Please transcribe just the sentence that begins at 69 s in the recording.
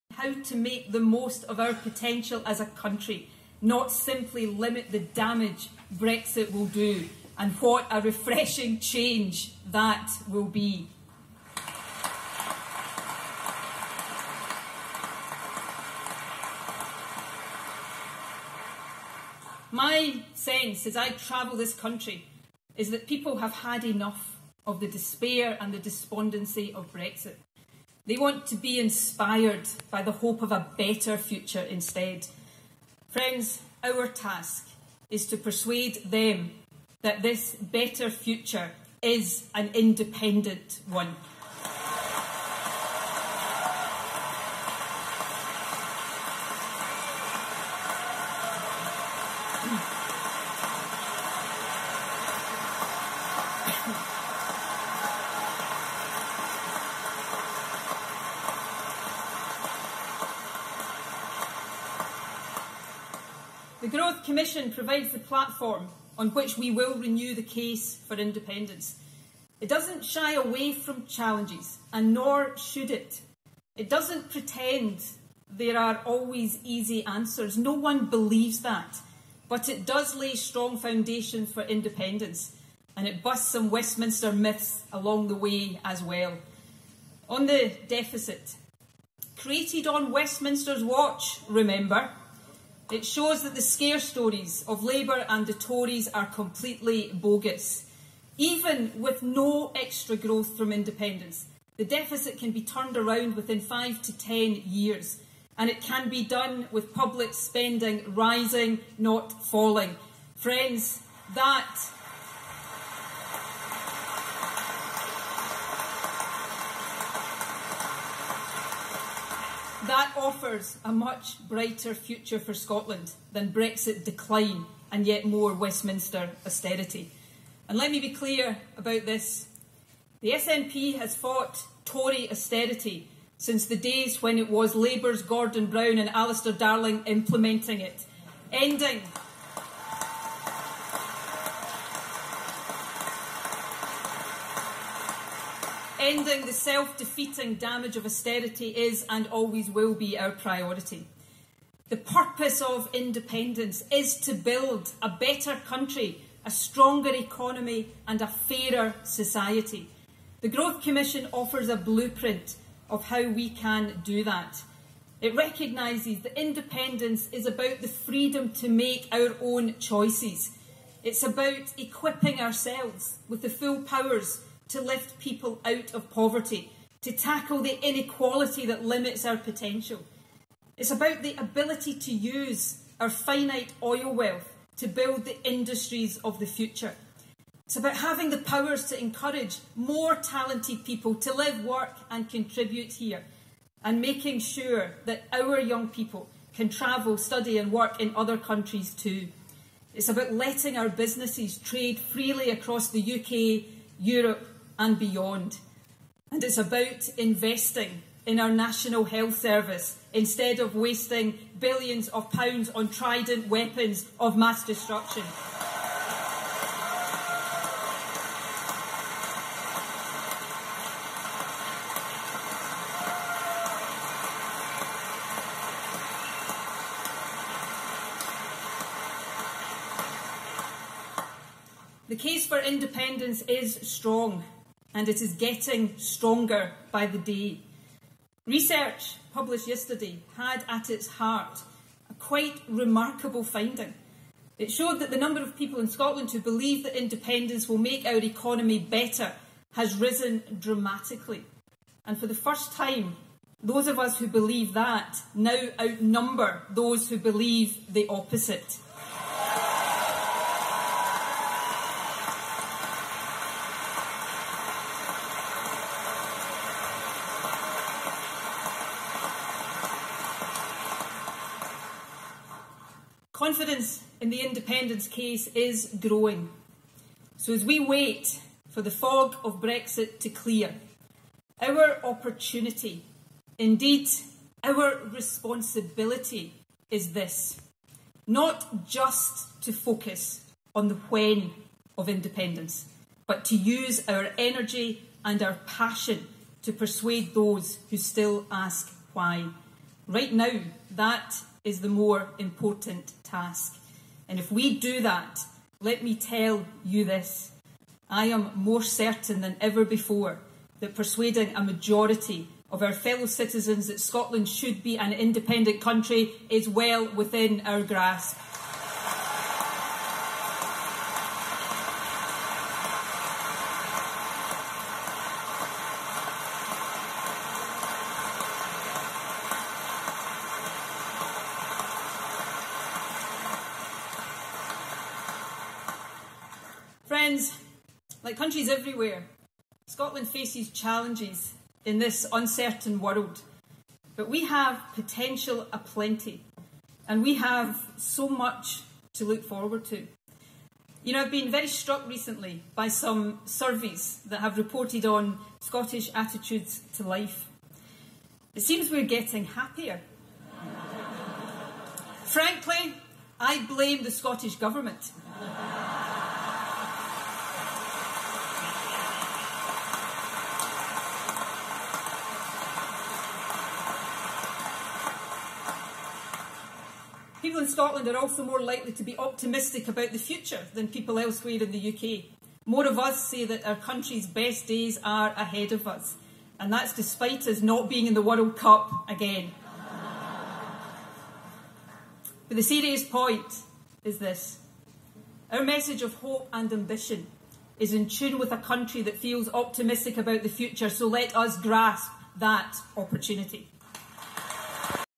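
It doesn't shy away from challenges, and nor should it.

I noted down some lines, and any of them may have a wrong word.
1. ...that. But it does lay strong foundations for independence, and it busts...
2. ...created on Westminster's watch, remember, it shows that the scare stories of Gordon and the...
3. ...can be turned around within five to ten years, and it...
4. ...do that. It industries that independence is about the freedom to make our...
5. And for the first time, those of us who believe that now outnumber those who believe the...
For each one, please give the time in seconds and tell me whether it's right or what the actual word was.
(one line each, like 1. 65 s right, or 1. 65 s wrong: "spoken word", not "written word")
1. 78 s right
2. 89 s wrong: "Labour", not "Gordon"
3. 102 s right
4. 164 s wrong: "recognises", not "industries"
5. 252 s right.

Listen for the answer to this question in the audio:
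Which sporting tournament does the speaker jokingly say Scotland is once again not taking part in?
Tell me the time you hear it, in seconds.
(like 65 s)
388 s.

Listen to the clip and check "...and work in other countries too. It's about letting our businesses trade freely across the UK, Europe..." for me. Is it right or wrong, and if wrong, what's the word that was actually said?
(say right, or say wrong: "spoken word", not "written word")
right.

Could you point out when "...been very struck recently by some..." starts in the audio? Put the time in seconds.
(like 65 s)
351 s.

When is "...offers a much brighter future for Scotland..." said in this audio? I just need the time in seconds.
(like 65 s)
120 s.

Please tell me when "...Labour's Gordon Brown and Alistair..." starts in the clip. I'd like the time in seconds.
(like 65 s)
134 s.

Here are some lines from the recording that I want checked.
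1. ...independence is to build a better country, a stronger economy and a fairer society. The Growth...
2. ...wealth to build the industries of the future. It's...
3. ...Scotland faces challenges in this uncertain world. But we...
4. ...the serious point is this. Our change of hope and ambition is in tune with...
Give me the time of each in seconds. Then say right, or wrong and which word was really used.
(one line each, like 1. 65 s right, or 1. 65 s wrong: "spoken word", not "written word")
1. 152 s right
2. 184 s right
3. 339 s right
4. 392 s wrong: "message", not "change".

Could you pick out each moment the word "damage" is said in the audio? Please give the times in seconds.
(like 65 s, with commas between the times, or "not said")
4 s, 147 s.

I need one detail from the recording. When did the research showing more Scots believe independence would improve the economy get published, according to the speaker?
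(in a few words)
Yesterday.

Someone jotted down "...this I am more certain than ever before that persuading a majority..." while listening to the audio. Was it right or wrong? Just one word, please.
right.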